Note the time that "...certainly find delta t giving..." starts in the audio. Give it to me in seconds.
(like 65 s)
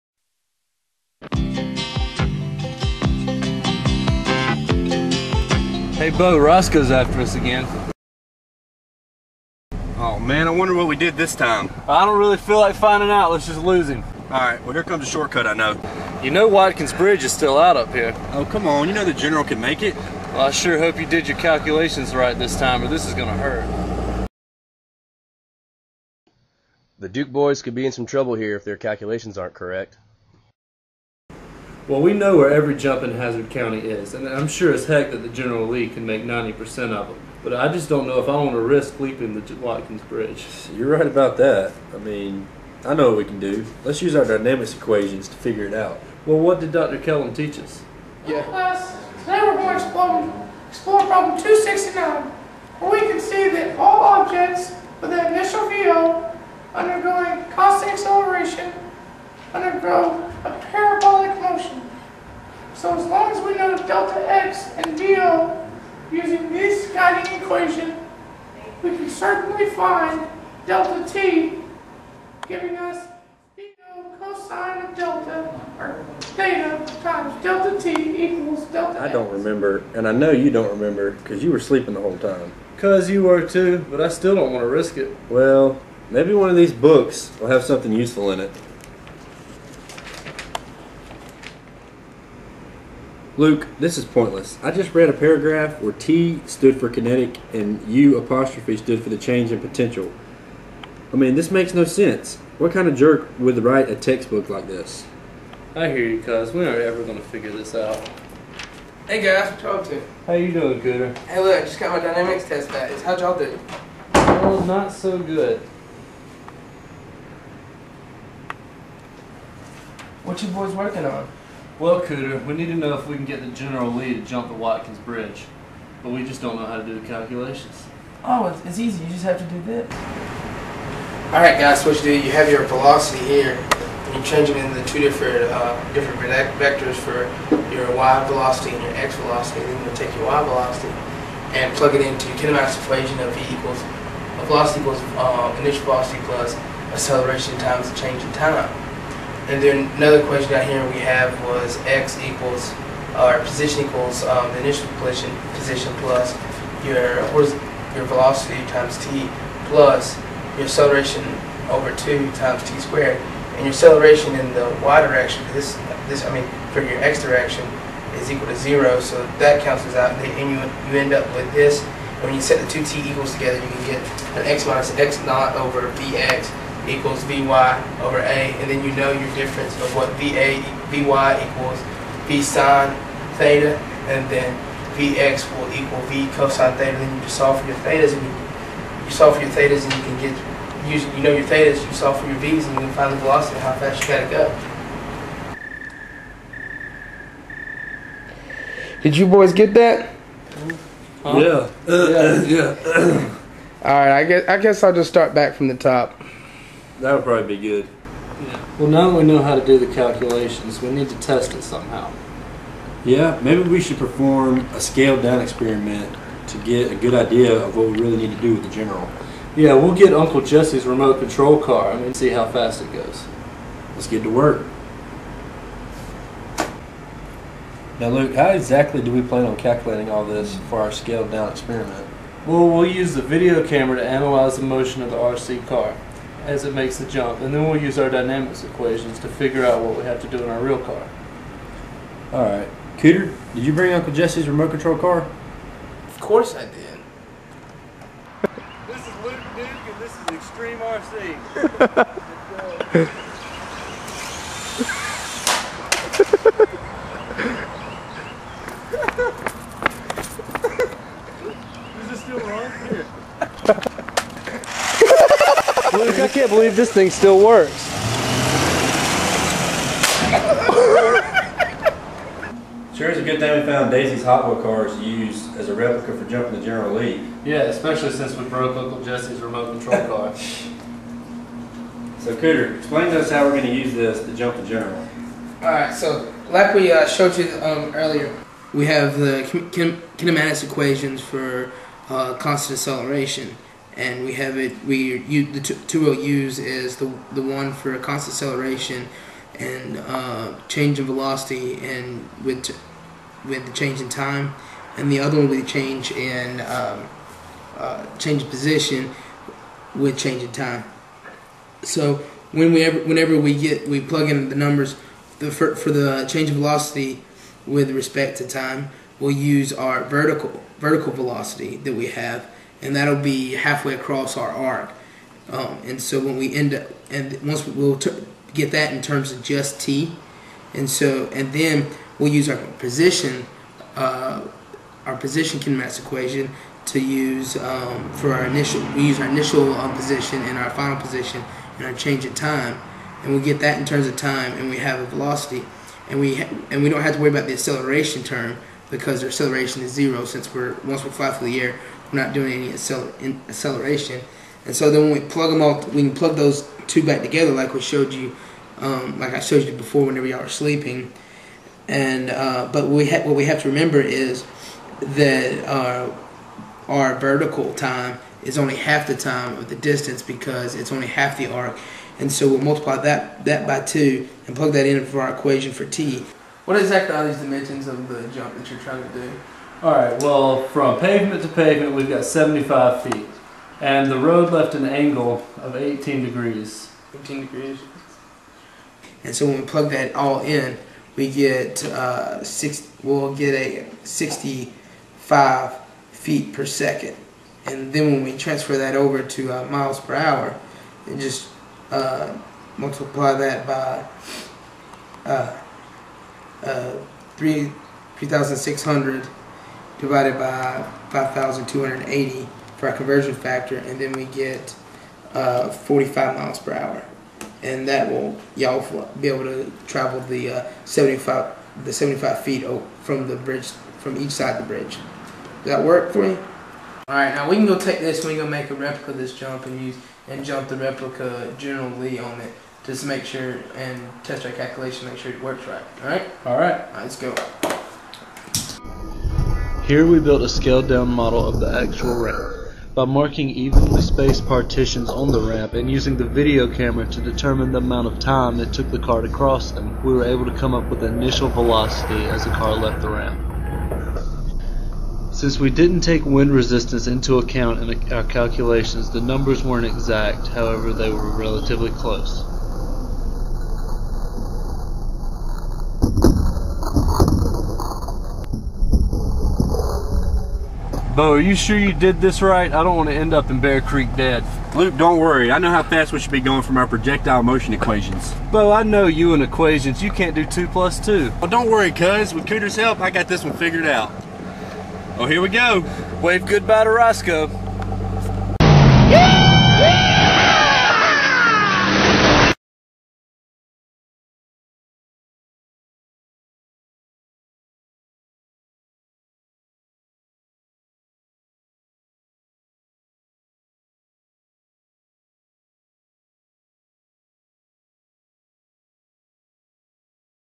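69 s.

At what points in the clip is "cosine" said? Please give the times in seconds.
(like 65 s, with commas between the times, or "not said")
74 s, 186 s.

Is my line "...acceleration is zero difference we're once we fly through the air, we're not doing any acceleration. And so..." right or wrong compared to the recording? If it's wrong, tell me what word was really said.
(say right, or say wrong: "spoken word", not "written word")
wrong: "since", not "difference".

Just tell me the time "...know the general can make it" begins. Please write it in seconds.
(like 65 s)
18 s.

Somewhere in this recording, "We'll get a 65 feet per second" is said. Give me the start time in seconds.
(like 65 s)
393 s.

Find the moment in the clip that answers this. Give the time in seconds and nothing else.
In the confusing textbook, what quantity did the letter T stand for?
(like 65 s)
96 s.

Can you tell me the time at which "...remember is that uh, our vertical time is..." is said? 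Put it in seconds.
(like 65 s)
363 s.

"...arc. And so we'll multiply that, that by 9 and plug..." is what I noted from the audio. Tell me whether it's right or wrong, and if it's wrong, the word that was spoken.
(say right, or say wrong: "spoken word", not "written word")
wrong: "2", not "9".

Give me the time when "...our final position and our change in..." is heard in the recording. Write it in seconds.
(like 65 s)
340 s.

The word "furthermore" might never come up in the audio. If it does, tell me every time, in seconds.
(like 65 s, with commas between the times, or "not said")
not said.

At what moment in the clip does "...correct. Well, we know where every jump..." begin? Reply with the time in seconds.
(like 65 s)
29 s.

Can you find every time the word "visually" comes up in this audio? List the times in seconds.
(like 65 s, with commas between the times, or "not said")
not said.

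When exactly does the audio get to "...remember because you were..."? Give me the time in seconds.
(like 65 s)
80 s.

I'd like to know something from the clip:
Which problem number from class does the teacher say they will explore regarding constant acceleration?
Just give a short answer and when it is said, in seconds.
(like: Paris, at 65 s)
269, at 51 s.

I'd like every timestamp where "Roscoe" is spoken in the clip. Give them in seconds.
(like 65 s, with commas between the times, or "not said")
6 s, 486 s.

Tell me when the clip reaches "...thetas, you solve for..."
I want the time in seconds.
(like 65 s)
191 s.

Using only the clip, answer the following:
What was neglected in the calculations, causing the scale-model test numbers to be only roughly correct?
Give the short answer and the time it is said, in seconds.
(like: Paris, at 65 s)
wind resistance, at 456 s.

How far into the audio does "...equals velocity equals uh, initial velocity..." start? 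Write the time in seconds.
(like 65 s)
143 s.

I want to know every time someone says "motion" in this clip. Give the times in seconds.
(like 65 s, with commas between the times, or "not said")
234 s, 477 s.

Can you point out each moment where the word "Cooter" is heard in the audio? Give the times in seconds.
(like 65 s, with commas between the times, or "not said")
110 s, 121 s, 242 s, 282 s, 482 s.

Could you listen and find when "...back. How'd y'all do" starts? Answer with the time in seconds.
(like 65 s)
112 s.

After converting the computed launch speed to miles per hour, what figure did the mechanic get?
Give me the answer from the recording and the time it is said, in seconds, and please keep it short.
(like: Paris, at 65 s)
45 miles per hour, at 415 s.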